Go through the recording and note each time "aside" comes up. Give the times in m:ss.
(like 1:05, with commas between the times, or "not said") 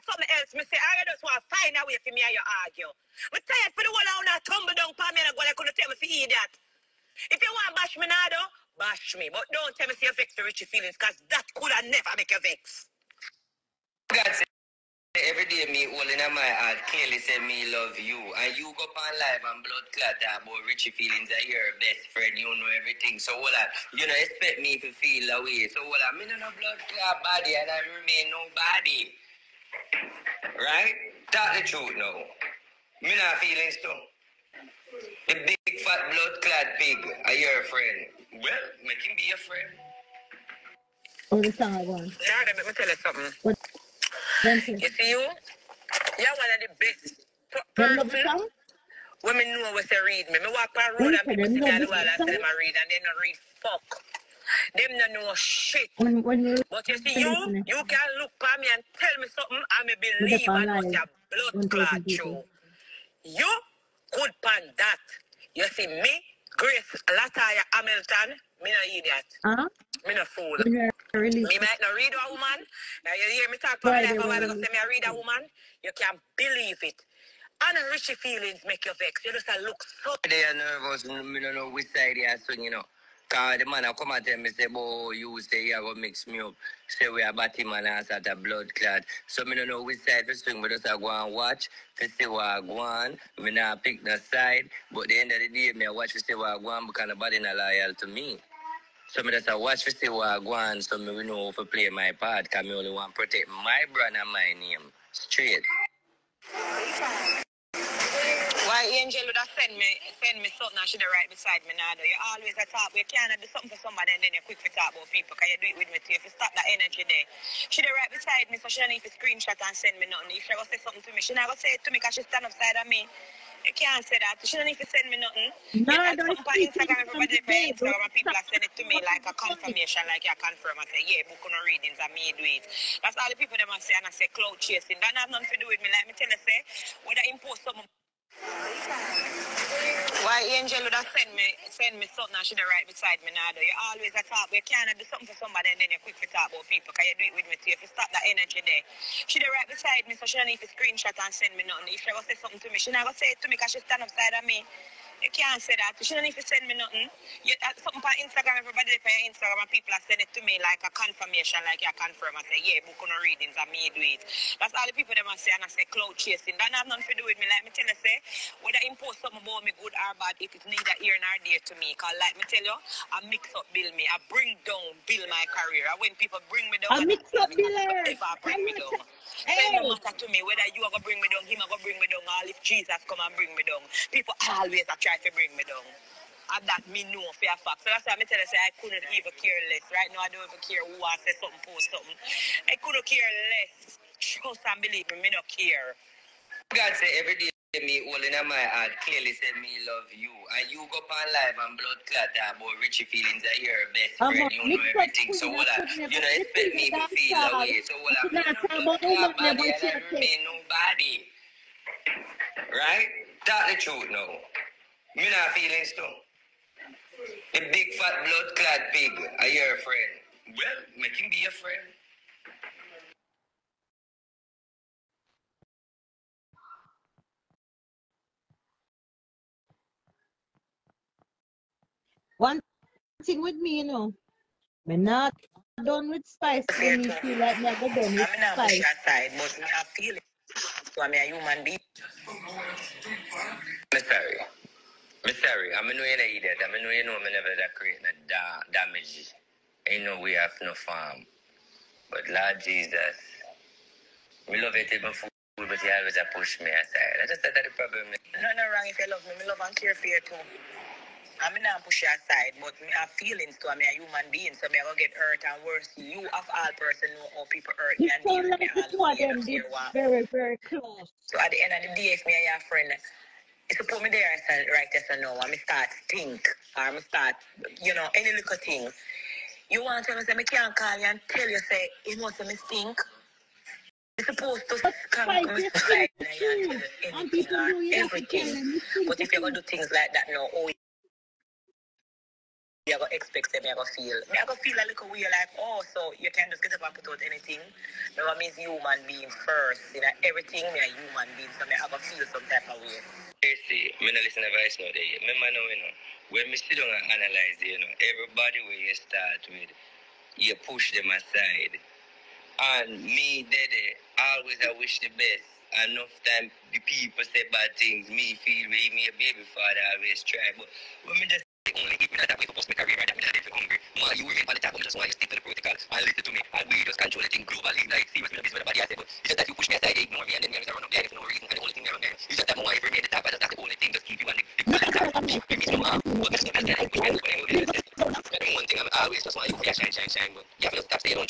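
4:16, 4:22, 5:11, 5:29.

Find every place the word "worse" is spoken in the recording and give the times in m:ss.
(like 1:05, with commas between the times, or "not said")
4:25.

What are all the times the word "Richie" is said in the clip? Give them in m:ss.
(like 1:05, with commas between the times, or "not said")
0:10, 0:20, 3:22.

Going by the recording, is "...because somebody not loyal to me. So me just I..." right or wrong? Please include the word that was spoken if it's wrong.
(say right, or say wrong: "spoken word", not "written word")
wrong: "nobody", not "somebody".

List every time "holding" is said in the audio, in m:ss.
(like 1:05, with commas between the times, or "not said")
0:15, 3:18.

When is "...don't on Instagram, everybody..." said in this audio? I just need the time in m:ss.
2:06.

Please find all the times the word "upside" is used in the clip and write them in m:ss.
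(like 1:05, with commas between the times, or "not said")
2:02, 2:34.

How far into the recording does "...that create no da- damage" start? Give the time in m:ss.
4:07.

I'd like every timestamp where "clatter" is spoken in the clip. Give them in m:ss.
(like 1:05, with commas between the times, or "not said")
3:22.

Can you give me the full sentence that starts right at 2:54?
I bring down build my career.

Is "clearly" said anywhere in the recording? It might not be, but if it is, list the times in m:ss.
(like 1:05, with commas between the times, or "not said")
0:16, 3:19.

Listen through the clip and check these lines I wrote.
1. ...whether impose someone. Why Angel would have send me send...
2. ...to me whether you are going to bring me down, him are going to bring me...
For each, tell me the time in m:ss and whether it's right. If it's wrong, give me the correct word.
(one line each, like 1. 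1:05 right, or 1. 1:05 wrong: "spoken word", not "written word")
1. 2:17 right
2. 3:00 right.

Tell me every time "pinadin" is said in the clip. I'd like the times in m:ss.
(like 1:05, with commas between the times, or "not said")
5:23.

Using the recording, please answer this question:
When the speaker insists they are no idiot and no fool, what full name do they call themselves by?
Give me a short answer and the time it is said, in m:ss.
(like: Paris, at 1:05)
Grace Latoya Hamilton, at 1:06.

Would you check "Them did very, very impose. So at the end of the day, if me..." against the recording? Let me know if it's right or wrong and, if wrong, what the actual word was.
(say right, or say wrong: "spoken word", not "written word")
wrong: "close", not "impose".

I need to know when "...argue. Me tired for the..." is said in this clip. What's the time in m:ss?
0:02.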